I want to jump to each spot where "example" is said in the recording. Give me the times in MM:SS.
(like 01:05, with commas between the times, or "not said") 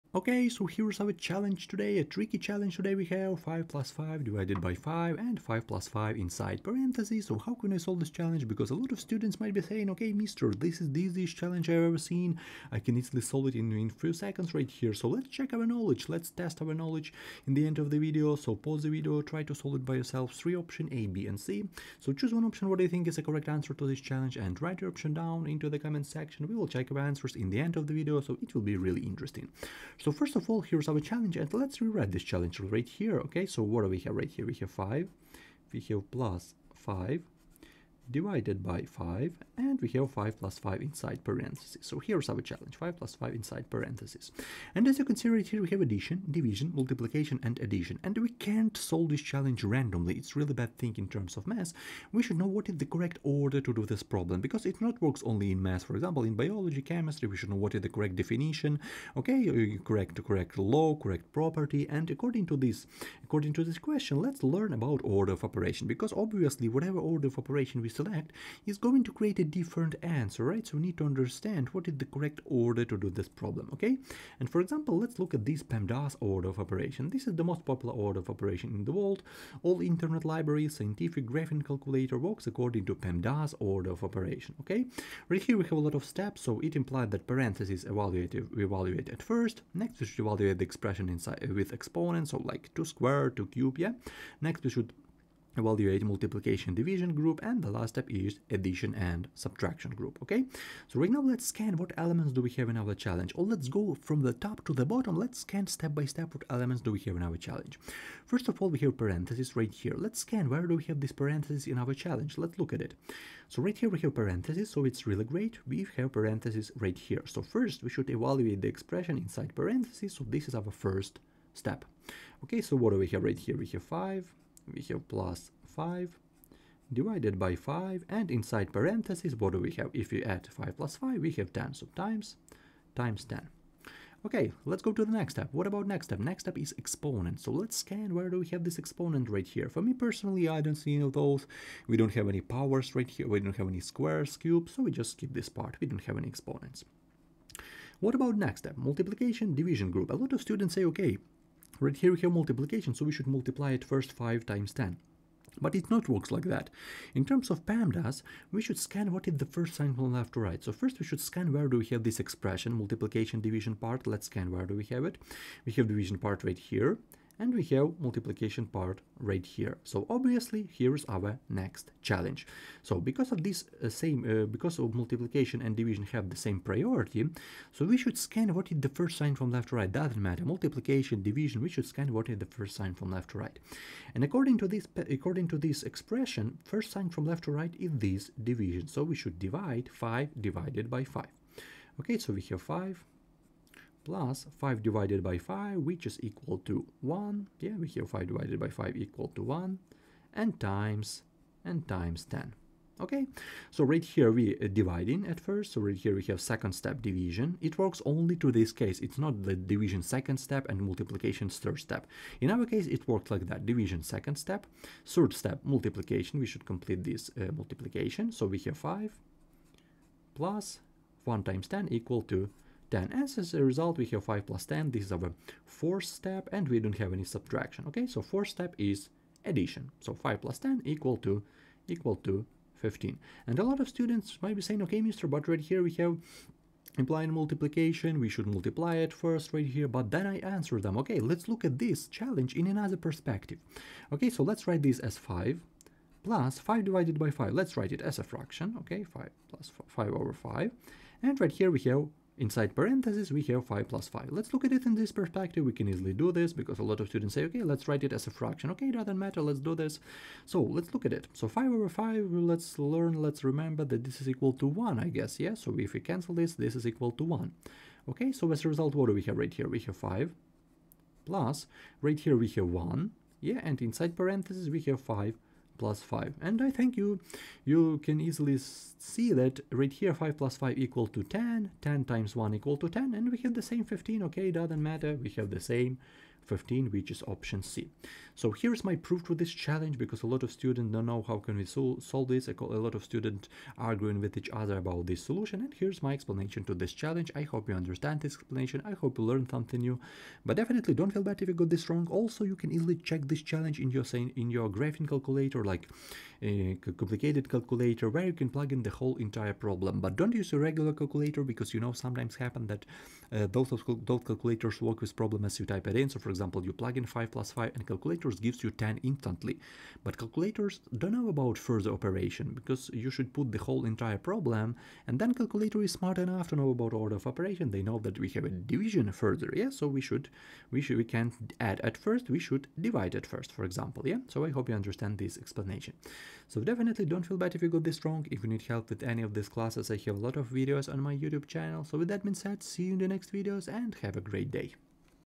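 00:55, 01:14, 05:16, 05:33.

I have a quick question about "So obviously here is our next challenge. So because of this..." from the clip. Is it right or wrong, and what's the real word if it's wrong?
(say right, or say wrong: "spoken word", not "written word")
right.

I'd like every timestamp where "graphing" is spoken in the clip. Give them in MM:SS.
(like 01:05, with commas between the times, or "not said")
01:21, 05:04.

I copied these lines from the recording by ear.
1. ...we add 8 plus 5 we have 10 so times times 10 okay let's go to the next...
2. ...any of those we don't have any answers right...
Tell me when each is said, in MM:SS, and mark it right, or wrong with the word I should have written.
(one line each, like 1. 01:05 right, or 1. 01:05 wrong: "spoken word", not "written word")
1. 02:10 wrong: "5", not "8"
2. 02:20 wrong: "powers", not "answers".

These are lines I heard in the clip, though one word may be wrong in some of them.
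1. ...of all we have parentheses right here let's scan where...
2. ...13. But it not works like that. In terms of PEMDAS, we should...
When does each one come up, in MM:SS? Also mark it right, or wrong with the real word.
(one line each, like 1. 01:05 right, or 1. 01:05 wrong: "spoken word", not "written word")
1. 01:48 right
2. 02:34 wrong: "10", not "13".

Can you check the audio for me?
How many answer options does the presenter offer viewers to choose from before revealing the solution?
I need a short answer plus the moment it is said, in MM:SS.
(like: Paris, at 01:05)
3, at 00:20.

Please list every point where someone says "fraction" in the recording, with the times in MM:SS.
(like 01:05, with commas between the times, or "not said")
04:08, 04:18.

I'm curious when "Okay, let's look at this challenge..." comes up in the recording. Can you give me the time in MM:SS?
04:00.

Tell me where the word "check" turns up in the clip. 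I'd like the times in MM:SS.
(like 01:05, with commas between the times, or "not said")
00:15, 00:26, 05:02.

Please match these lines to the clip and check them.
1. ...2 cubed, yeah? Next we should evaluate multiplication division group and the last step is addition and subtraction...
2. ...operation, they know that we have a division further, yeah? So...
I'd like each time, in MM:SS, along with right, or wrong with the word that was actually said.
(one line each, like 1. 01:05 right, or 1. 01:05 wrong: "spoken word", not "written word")
1. 01:33 right
2. 05:27 right.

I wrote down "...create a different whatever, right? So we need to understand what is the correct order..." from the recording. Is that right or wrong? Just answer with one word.
wrong.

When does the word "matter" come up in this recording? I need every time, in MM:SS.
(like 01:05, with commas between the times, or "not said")
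03:00, 04:19, 04:44.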